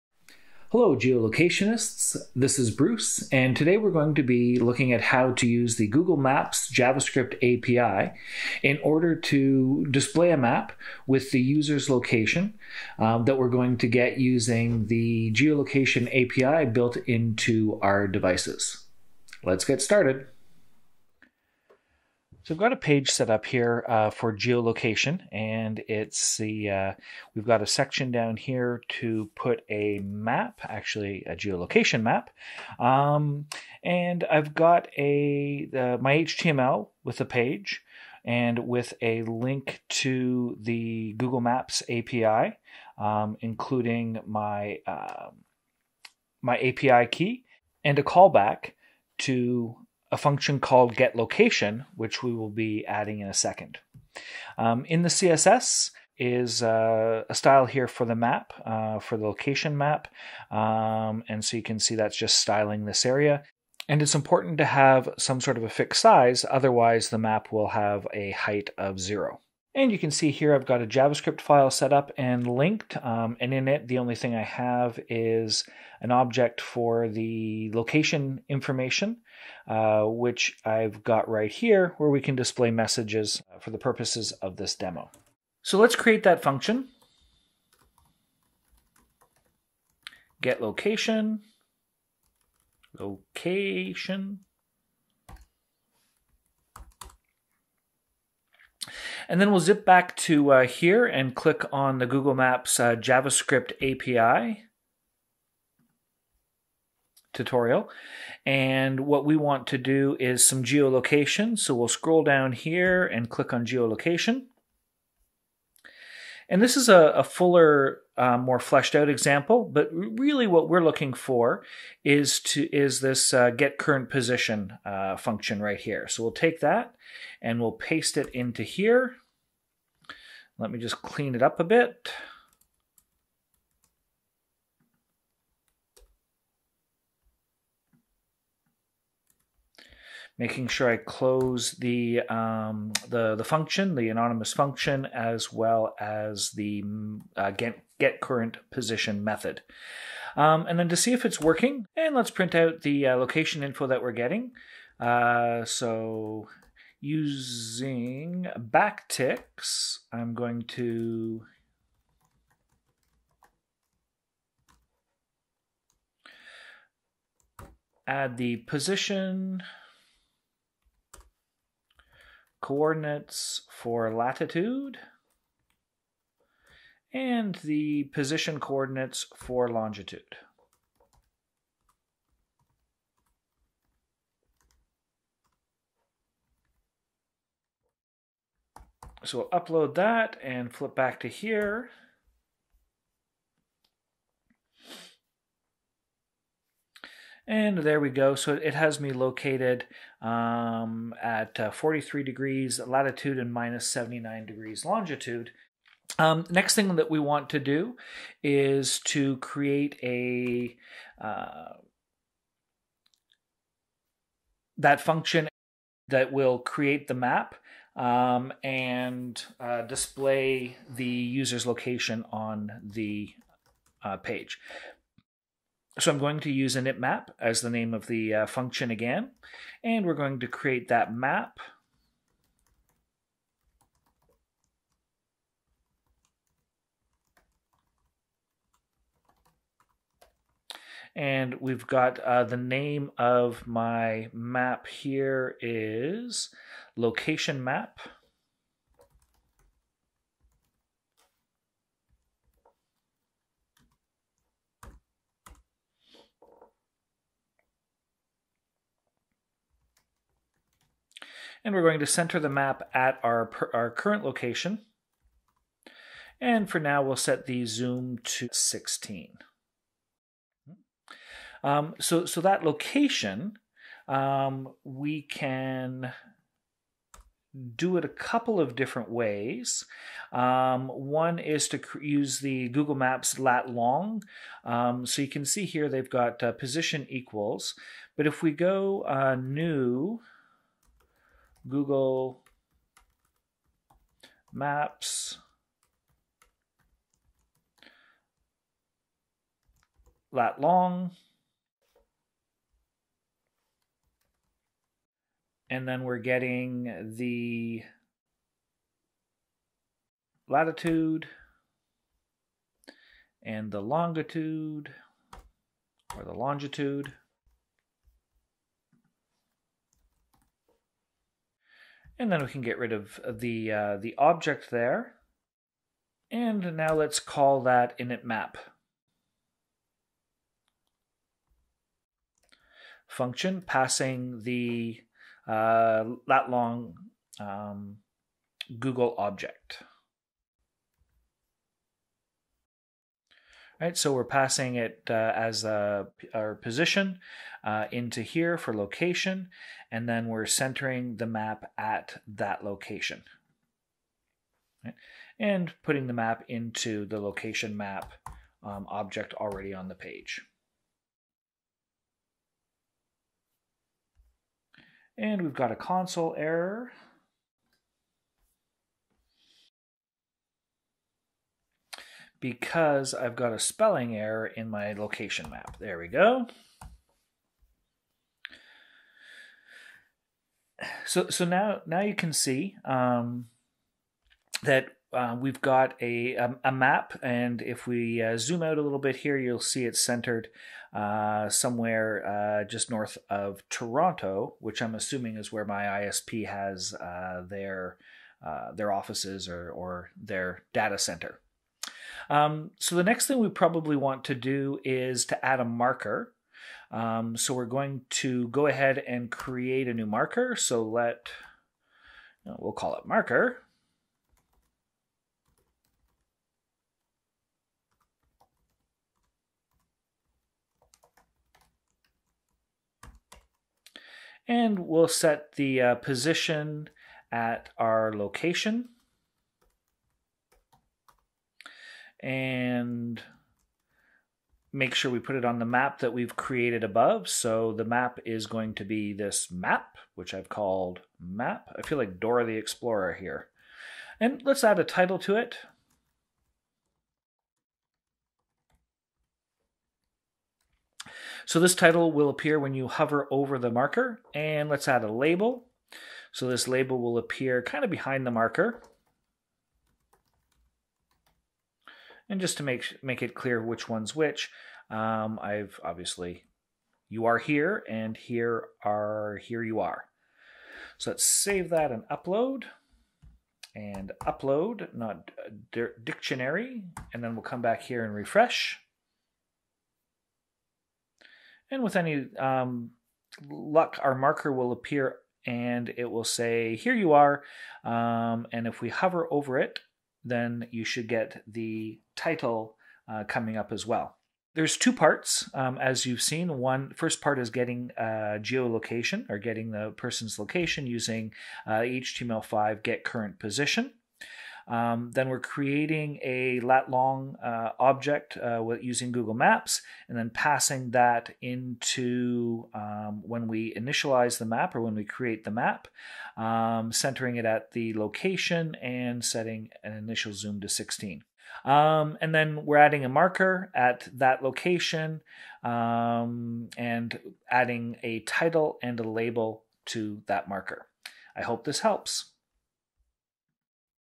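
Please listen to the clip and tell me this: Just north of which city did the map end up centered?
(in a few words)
Toronto.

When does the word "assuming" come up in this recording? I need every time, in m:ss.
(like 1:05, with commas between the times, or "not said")
6:34.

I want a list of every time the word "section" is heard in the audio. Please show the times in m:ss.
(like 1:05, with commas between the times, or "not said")
0:27.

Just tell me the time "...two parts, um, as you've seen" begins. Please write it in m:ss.
8:14.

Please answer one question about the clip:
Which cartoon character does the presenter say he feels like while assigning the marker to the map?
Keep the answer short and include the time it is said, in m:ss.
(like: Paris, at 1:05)
Dora the Explorer, at 7:22.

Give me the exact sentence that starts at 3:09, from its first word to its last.
So we'll upload that and flip back to here And there we go.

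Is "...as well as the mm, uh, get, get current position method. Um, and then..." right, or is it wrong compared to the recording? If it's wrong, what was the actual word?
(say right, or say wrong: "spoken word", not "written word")
right.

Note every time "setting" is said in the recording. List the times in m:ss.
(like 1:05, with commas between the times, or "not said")
8:39.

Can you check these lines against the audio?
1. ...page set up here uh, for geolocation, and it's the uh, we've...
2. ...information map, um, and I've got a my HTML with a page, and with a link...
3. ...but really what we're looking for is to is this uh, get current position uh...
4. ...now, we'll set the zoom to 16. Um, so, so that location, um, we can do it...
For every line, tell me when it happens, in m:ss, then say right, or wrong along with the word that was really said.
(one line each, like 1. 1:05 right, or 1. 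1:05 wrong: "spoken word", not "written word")
1. 0:22 right
2. 0:31 wrong: "geolocation", not "information"
3. 1:59 right
4. 4:26 right.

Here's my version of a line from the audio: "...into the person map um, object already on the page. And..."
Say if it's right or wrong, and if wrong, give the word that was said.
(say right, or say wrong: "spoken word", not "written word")
wrong: "location", not "person".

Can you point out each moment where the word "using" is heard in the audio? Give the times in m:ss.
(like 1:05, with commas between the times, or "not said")
0:14, 2:37, 8:20, 8:28.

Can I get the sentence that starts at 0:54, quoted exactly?
Um, in the CSS is uh, a style here for the map, uh, for the location map.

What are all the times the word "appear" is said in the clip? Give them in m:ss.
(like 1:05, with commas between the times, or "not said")
7:32, 7:37, 8:04.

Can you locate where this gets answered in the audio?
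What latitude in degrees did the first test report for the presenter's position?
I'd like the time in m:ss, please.
3:21.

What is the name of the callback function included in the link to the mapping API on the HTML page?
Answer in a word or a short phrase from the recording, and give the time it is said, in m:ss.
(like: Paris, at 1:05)
getLocation, at 0:50.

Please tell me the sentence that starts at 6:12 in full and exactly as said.
because I've got a spelling error in my location map.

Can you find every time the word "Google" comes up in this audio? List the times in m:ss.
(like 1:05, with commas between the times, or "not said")
0:05, 0:41, 1:42, 4:42, 4:51, 5:38, 8:29.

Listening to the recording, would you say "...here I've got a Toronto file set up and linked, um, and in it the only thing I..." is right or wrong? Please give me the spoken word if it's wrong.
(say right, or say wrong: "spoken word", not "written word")
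wrong: "JavaScript", not "Toronto".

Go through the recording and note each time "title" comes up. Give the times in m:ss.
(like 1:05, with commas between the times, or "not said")
7:24, 7:31, 8:12, 8:48.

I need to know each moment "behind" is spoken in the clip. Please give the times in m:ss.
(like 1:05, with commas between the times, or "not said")
7:37.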